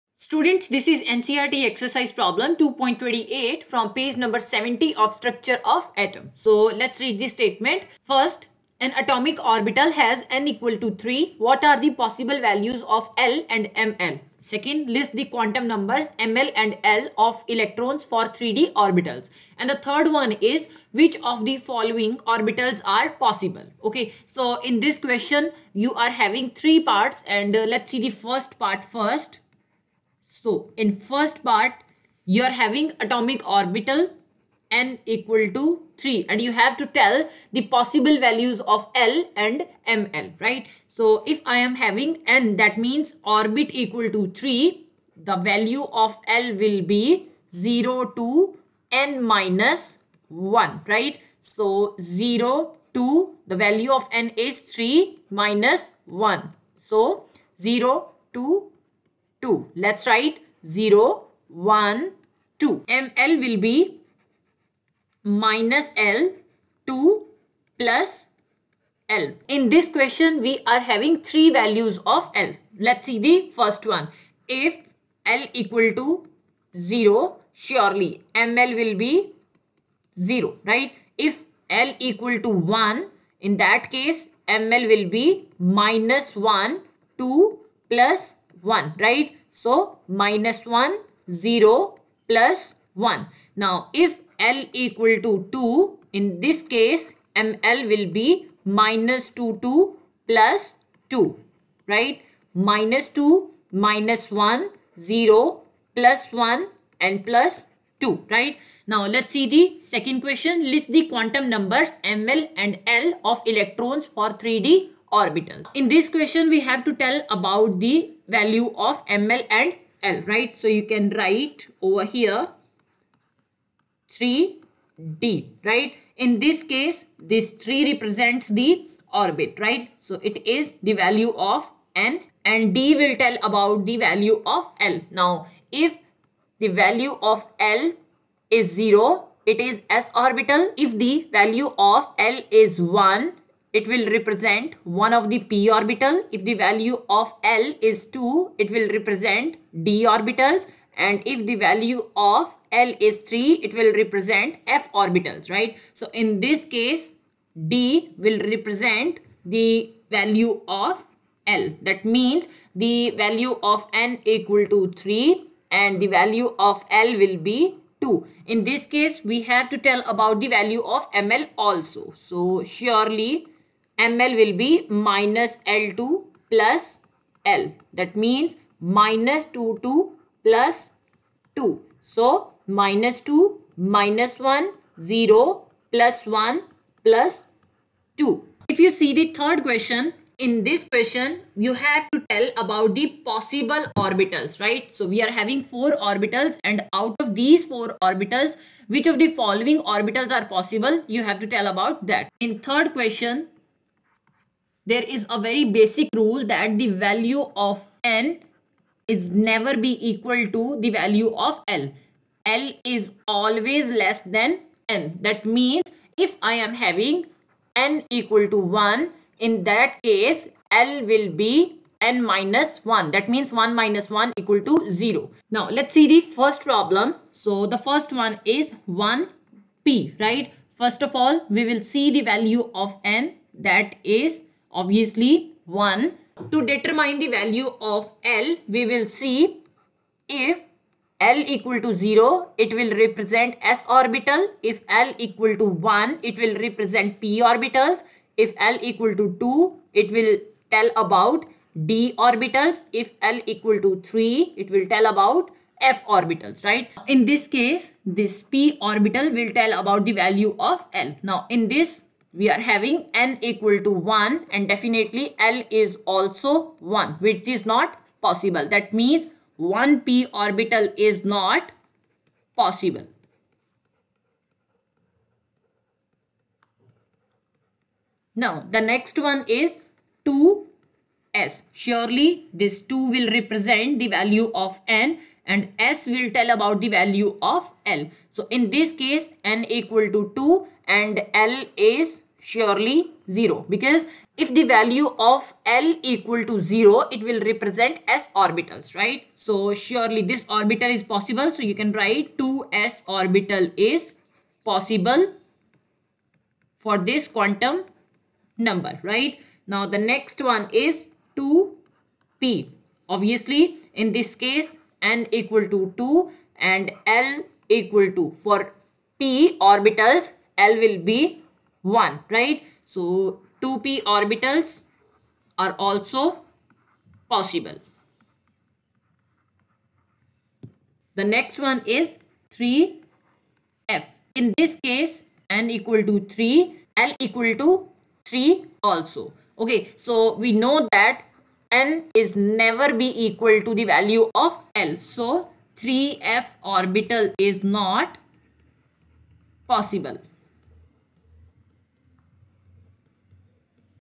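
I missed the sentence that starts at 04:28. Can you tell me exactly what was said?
That means 1p orbital is not possible.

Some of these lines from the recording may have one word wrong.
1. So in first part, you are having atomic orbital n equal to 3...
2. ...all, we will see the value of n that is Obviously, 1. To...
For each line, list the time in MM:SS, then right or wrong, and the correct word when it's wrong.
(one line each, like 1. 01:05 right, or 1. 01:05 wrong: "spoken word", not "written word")
1. 00:30 right
2. 03:51 right.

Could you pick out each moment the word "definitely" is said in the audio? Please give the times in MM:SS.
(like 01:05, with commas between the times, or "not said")
04:24.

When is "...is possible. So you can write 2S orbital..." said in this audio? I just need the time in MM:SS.
05:00.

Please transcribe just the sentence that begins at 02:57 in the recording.
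That means minus 2 2 plus 2.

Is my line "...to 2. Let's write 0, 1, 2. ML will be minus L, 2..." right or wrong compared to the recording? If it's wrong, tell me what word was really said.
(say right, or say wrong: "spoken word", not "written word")
right.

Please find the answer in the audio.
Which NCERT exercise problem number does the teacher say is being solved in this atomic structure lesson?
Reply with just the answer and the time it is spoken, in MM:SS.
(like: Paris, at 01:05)
2.28, at 00:02.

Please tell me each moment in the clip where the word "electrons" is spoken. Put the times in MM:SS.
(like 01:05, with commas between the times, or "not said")
00:17, 01:53.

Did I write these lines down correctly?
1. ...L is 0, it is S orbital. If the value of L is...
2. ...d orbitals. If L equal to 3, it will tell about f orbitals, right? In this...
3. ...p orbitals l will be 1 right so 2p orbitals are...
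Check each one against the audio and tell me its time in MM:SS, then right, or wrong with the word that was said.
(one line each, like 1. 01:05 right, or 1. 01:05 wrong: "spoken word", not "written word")
1. 02:17 right
2. 04:11 right
3. 05:19 right.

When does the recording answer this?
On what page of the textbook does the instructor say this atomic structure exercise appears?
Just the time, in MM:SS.
00:03.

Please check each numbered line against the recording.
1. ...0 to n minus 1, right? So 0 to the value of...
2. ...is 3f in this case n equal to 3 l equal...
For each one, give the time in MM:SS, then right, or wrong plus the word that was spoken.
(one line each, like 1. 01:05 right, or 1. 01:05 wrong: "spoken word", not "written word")
1. 00:47 right
2. 05:31 right.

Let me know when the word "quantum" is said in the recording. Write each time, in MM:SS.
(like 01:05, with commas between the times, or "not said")
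00:15, 01:51, 05:07.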